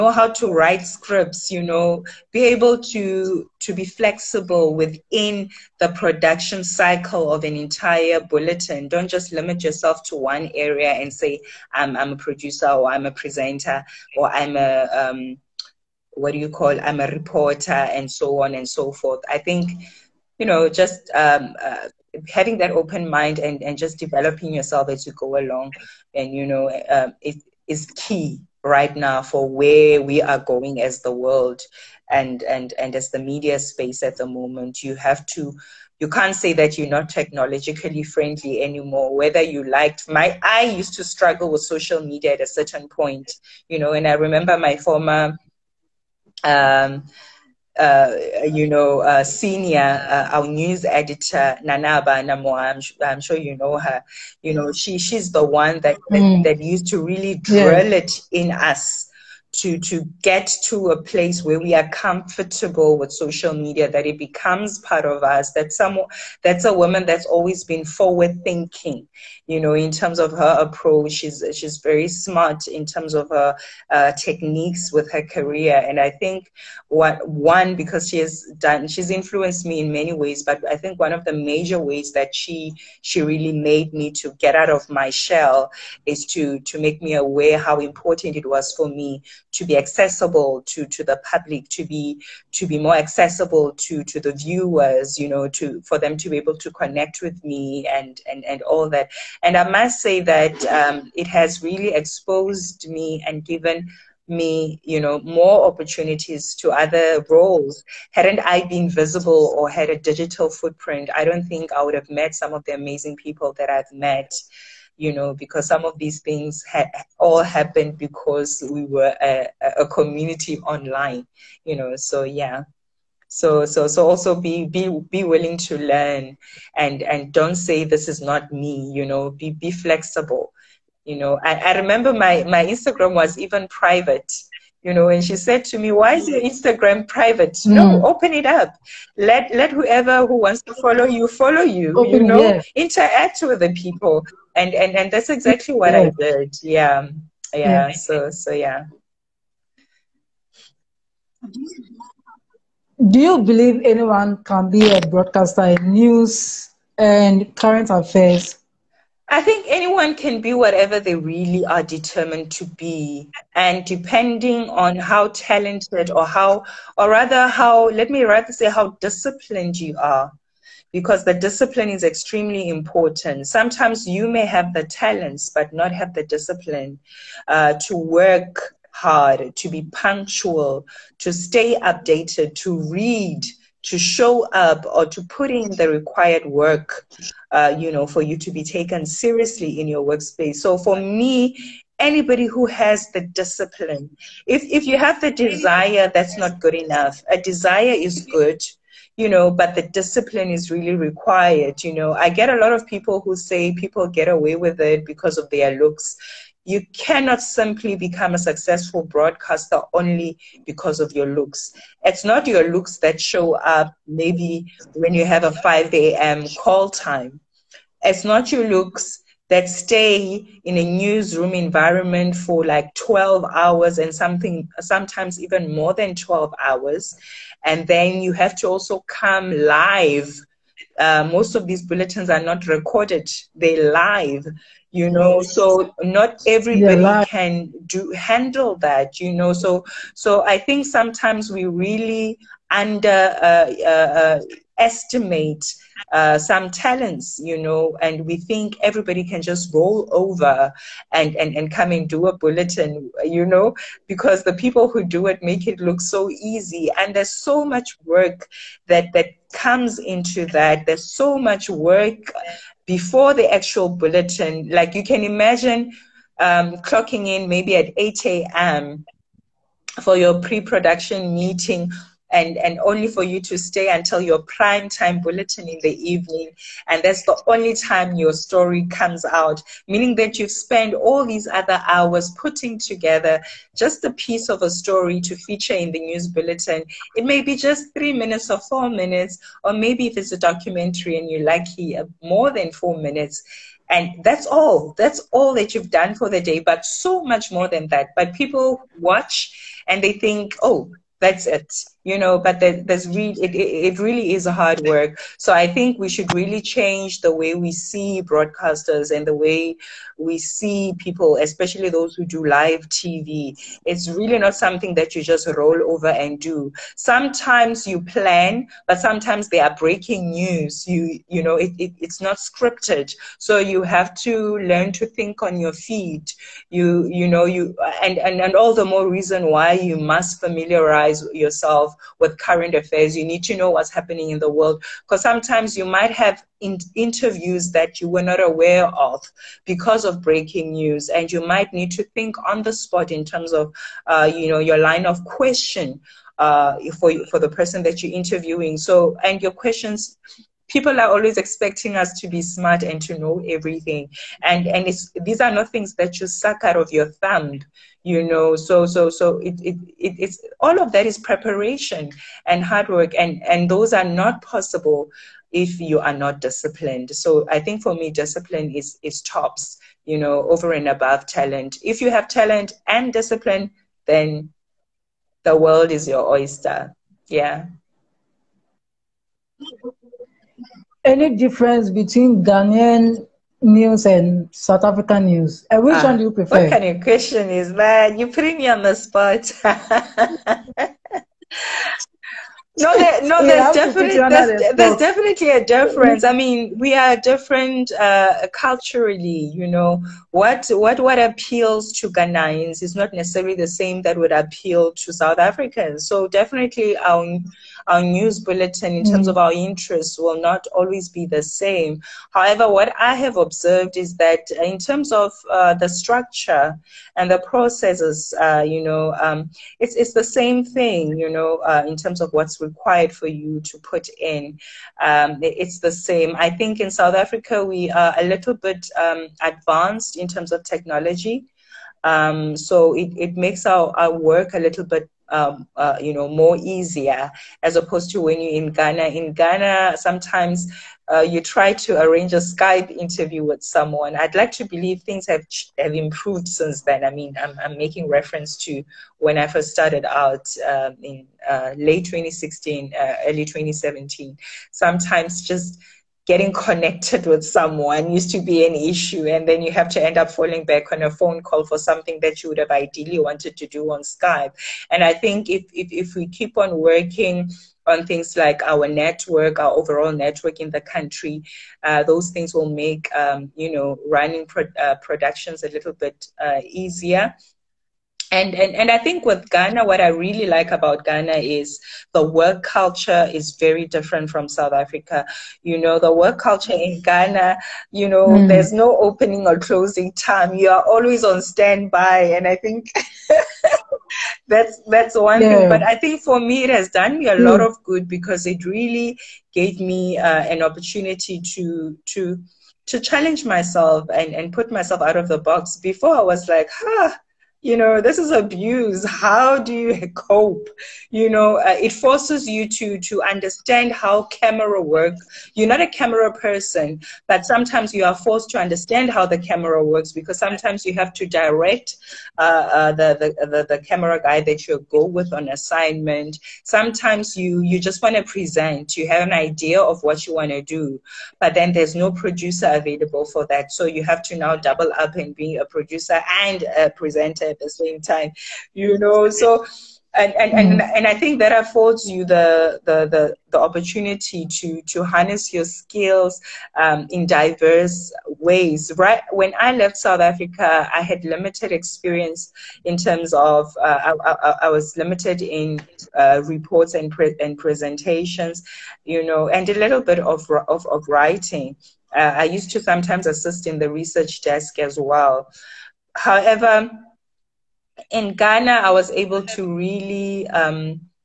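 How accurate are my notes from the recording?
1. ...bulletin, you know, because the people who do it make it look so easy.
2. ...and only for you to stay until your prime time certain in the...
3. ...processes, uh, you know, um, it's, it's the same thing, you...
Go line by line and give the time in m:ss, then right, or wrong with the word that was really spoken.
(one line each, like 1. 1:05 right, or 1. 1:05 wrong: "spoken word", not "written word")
1. 4:12 right
2. 4:32 wrong: "bulletin", not "certain"
3. 6:57 right.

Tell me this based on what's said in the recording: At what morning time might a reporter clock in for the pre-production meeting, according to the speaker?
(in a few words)
8 a.m.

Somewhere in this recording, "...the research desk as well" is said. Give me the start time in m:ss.
9:23.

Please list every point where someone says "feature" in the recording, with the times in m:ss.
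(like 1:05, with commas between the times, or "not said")
4:45.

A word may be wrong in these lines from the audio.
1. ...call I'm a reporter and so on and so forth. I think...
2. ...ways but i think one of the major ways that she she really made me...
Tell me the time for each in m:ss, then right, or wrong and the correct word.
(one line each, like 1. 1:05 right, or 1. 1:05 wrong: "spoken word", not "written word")
1. 0:16 right
2. 1:20 right.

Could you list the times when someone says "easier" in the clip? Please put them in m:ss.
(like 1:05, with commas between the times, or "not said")
7:16, 7:56.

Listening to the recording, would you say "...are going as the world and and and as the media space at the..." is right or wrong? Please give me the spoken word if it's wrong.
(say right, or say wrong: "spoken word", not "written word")
right.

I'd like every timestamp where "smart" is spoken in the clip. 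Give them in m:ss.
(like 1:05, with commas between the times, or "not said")
1:12, 5:52.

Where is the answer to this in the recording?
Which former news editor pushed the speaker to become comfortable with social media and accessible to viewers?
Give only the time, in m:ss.
0:51.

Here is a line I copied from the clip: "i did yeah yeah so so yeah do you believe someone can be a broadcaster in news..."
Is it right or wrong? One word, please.
wrong.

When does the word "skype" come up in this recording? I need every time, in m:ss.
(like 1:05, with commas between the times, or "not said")
7:22, 7:44.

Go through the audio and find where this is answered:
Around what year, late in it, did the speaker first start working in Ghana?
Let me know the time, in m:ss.
7:31.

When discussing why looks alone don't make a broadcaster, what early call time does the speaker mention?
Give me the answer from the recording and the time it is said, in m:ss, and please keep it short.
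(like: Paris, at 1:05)
5 a.m., at 3:35.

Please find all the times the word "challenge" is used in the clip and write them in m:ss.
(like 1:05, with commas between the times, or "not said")
8:22.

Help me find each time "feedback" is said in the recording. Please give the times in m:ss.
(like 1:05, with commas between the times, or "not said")
not said.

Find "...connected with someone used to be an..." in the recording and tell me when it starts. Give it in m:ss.
7:36.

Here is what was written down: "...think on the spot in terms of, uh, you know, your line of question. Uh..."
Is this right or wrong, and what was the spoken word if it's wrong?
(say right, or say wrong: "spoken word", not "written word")
right.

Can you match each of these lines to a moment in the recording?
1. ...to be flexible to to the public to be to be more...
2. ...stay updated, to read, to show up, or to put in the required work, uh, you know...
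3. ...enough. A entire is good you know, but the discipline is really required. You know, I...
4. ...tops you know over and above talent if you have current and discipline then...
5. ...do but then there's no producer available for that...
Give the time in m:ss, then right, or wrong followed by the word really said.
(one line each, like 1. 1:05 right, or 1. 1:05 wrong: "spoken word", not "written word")
1. 1:29 wrong: "accessible", not "flexible"
2. 3:01 right
3. 3:16 wrong: "desire", not "entire"
4. 6:09 wrong: "talent", not "current"
5. 8:50 right.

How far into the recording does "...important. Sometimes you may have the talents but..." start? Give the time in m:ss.
2:52.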